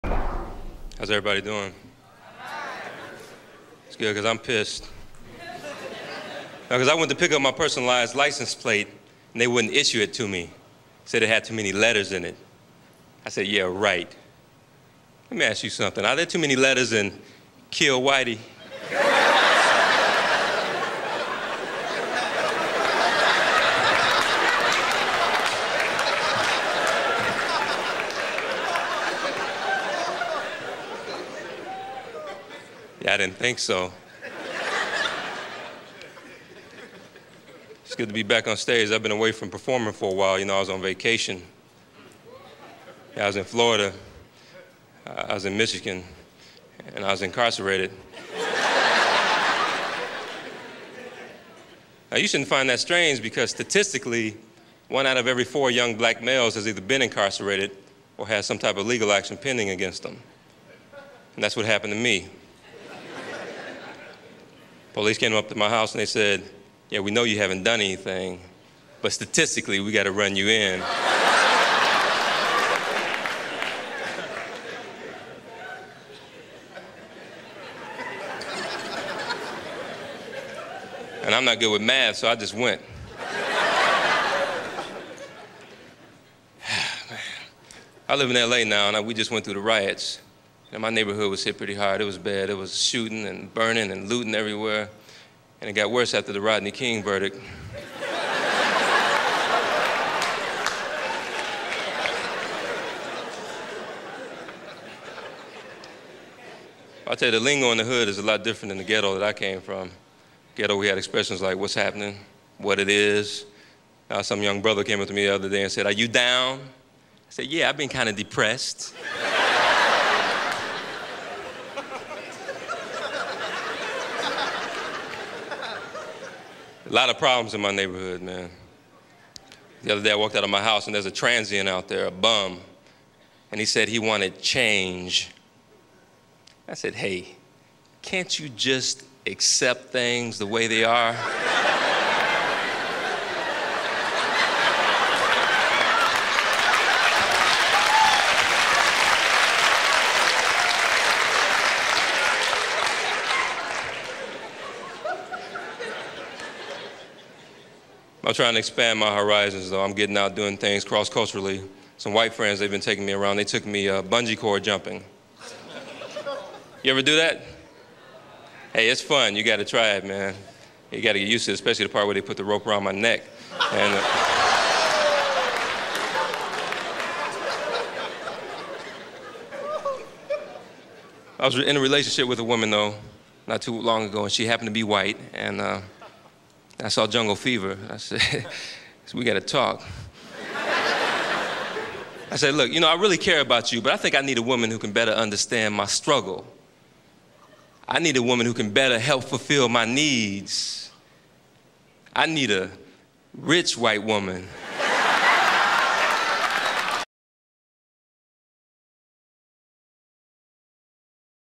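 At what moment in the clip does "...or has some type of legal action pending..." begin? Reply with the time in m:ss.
0:58.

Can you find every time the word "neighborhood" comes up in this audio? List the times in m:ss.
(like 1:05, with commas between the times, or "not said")
1:30, 2:07.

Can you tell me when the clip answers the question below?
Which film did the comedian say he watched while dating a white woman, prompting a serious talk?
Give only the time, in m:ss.
3:07.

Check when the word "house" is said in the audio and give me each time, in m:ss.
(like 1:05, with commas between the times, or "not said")
1:05, 2:10.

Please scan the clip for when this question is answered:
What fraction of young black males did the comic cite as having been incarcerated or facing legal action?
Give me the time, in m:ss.
0:54.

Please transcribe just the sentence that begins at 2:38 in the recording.
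I'm trying to expand my horizons, though.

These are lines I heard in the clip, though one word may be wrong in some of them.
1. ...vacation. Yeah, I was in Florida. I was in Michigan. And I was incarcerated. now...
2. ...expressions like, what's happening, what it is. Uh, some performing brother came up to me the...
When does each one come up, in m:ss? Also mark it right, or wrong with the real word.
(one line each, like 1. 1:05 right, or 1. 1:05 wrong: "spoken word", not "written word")
1. 0:40 right
2. 1:50 wrong: "young", not "performing".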